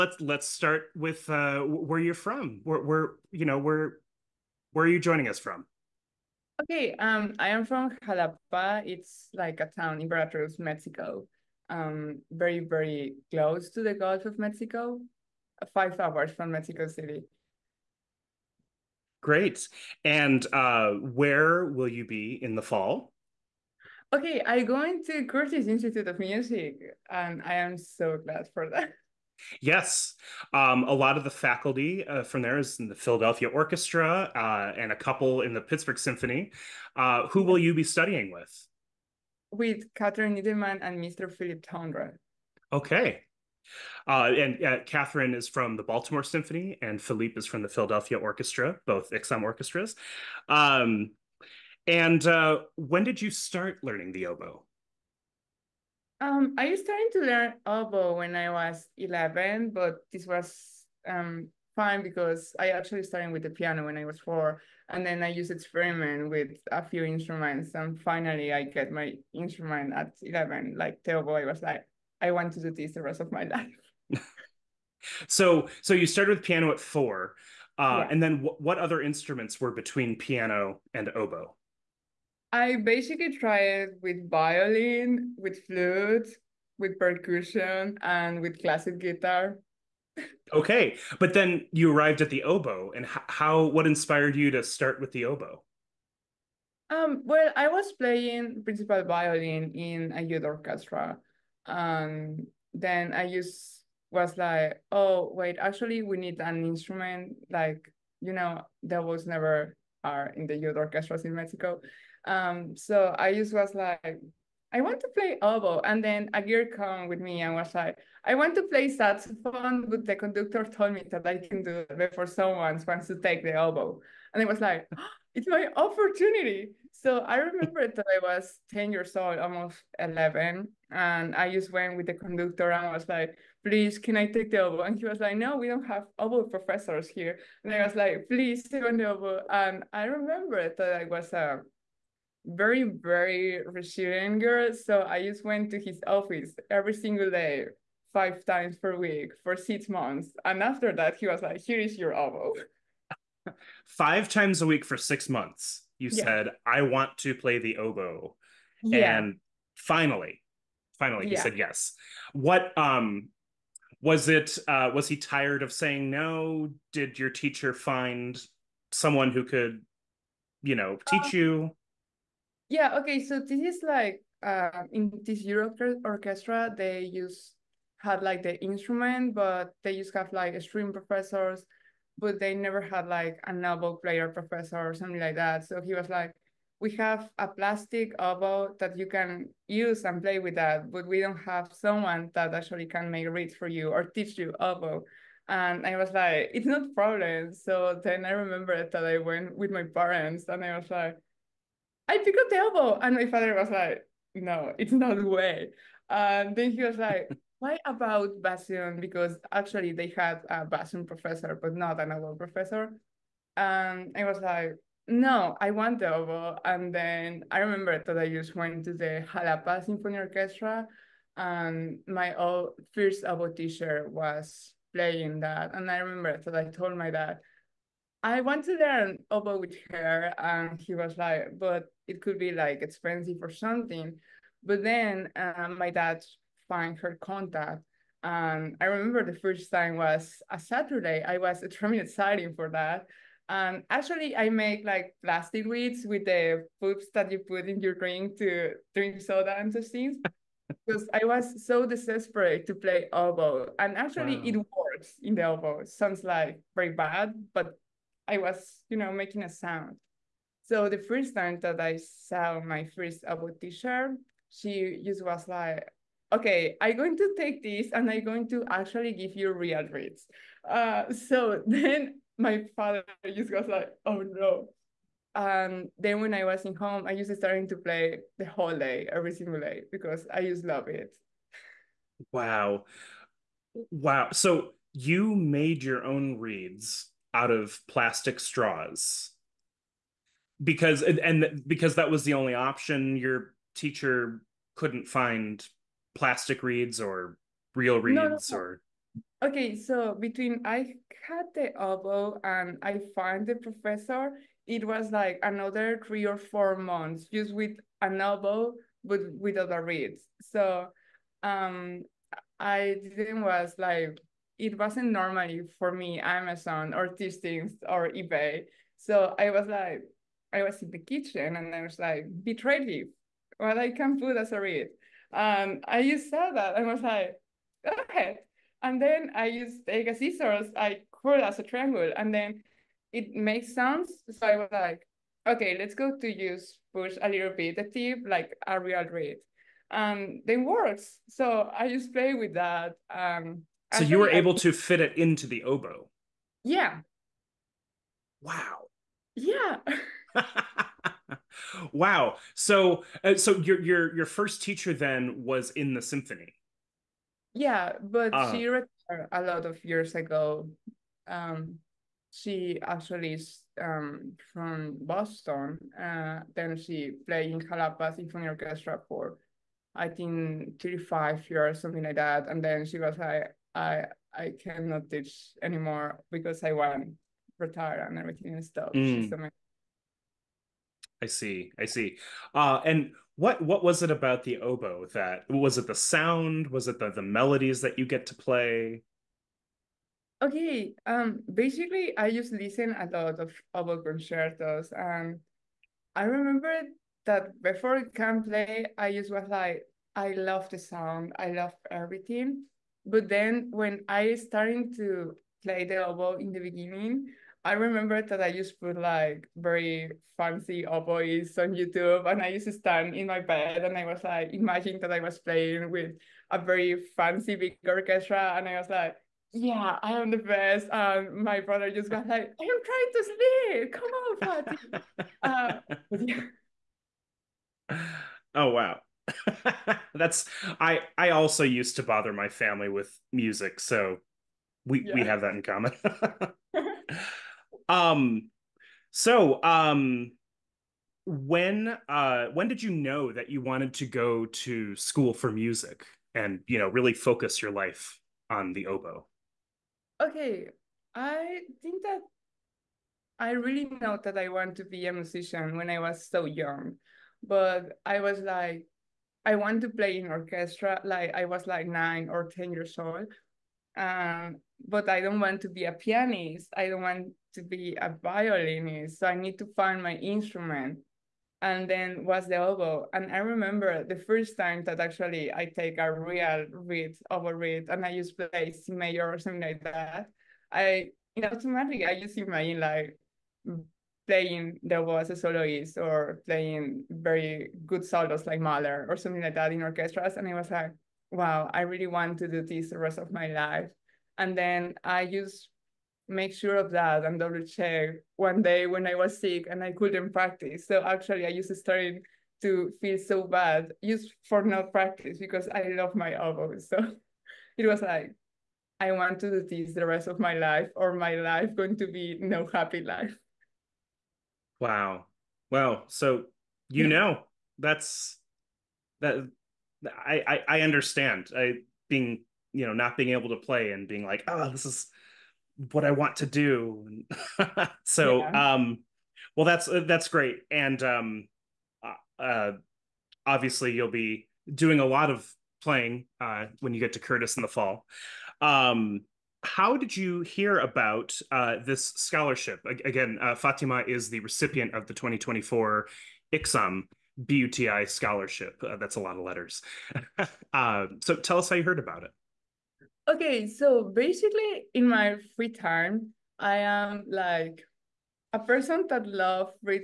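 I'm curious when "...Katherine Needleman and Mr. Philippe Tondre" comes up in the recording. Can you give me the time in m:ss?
0:39.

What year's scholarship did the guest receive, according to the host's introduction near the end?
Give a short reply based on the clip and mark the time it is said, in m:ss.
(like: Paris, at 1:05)
2024, at 9:05.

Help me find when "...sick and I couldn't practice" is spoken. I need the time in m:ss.
8:19.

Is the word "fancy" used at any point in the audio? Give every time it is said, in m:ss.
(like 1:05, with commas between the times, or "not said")
6:50, 6:57.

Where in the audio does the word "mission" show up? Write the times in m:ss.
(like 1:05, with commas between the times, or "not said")
not said.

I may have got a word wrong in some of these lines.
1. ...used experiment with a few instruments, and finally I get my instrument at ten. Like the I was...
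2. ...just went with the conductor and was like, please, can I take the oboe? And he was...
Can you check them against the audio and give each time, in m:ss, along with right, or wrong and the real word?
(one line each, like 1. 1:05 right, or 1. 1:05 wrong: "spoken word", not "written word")
1. 1:05 wrong: "eleven", not "ten"
2. 2:11 right.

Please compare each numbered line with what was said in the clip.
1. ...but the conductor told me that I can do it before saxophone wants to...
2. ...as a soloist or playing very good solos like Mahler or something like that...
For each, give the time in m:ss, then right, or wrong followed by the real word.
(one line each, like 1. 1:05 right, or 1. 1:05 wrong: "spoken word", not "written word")
1. 1:59 wrong: "someone", not "saxophone"
2. 8:05 right.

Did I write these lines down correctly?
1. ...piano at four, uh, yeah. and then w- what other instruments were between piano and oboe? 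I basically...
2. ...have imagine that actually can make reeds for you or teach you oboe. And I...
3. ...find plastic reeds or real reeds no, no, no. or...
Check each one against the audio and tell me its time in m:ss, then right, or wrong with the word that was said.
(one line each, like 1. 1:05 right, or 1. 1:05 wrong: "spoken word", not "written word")
1. 1:16 right
2. 3:11 wrong: "someone", not "imagine"
3. 4:55 right.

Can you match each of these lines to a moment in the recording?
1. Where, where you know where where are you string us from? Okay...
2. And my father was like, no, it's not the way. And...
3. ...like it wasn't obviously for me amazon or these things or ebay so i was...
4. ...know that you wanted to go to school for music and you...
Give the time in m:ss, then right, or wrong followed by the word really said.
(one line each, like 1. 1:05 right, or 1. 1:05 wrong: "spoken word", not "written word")
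1. 0:02 wrong: "joining", not "string"
2. 3:23 right
3. 5:13 wrong: "normally", not "obviously"
4. 7:22 right.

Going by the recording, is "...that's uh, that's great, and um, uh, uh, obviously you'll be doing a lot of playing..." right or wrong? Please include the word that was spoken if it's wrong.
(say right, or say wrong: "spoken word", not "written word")
right.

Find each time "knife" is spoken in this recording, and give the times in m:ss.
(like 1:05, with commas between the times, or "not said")
not said.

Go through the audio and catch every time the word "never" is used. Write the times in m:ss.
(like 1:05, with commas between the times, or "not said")
1:49, 3:02.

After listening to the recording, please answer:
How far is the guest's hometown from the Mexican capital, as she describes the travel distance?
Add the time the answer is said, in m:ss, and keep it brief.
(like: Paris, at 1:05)
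5 hours, at 0:15.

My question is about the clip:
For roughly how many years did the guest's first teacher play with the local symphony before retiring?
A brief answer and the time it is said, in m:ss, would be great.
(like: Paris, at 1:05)
35 years, at 6:10.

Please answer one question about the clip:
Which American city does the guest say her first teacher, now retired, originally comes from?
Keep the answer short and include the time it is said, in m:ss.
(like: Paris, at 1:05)
Boston, at 6:05.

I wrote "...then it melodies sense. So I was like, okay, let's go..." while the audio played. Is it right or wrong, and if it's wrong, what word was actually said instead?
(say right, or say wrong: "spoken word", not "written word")
wrong: "makes", not "melodies".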